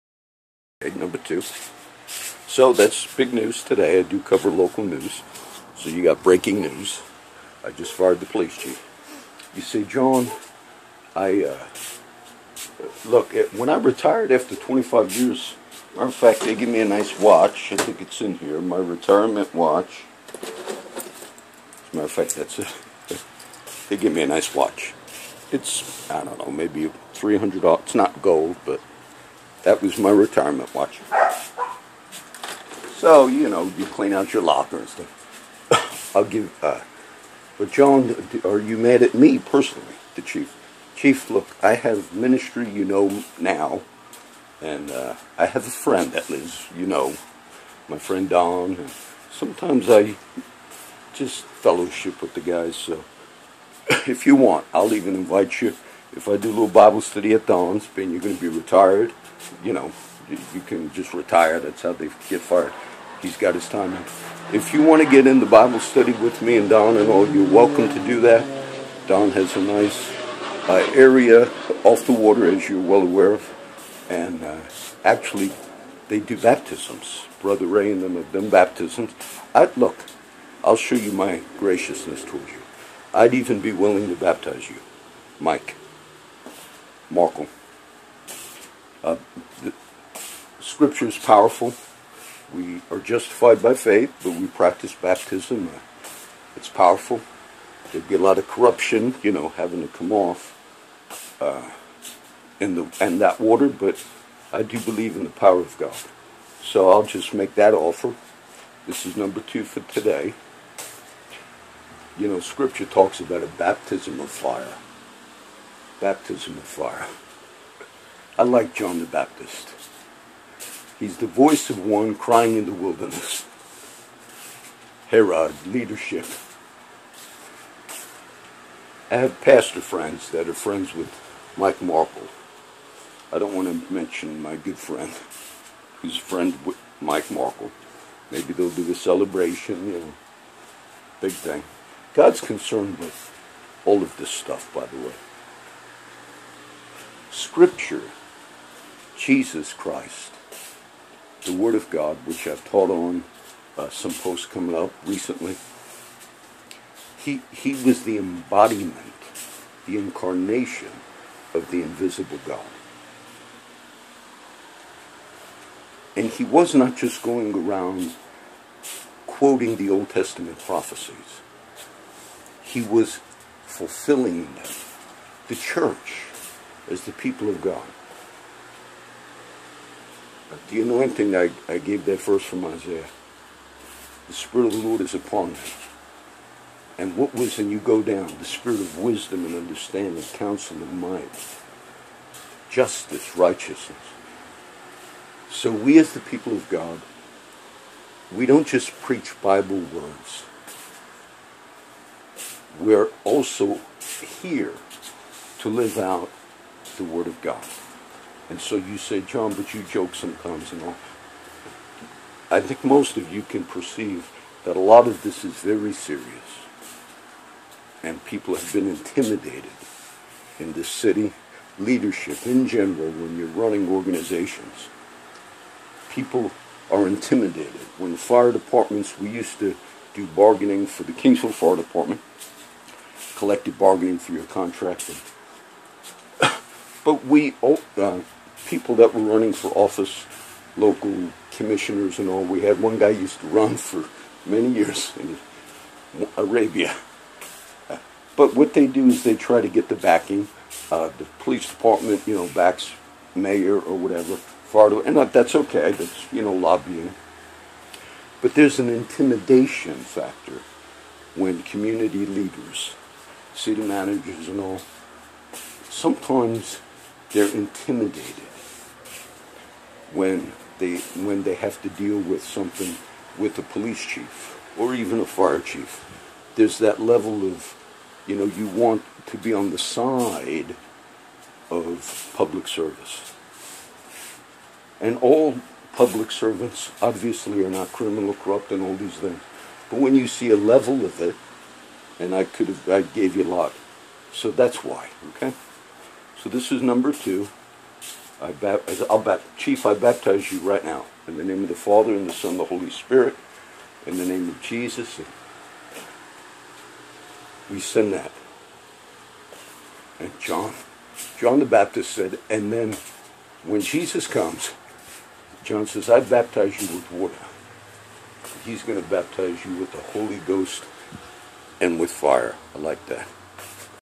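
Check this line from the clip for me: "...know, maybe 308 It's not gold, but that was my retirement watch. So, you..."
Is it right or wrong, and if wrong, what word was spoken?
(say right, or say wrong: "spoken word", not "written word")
wrong: "300", not "308".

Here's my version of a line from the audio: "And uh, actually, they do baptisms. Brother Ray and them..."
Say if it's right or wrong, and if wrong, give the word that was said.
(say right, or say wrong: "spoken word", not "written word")
right.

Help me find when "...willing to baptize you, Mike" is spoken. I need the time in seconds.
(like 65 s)
83 s.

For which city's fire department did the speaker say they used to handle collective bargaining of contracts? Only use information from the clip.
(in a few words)
Kingsville.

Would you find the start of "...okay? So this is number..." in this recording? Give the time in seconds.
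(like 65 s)
295 s.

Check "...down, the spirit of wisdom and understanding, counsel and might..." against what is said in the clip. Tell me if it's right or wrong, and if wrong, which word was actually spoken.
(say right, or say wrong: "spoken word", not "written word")
right.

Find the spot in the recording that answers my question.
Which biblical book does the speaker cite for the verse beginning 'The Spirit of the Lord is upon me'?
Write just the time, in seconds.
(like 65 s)
182 s.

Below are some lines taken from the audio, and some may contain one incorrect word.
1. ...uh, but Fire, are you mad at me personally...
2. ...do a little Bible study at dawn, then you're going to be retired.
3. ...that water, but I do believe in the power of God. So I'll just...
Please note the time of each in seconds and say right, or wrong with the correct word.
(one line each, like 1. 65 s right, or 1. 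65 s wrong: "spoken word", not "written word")
1. 36 s wrong: "John", not "Fire"
2. 56 s right
3. 103 s right.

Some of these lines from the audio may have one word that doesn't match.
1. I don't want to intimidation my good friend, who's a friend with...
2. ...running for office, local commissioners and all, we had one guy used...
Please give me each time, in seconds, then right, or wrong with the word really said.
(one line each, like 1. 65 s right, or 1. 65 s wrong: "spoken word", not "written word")
1. 133 s wrong: "mention", not "intimidation"
2. 239 s right.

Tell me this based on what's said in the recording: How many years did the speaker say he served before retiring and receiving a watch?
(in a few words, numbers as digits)
25.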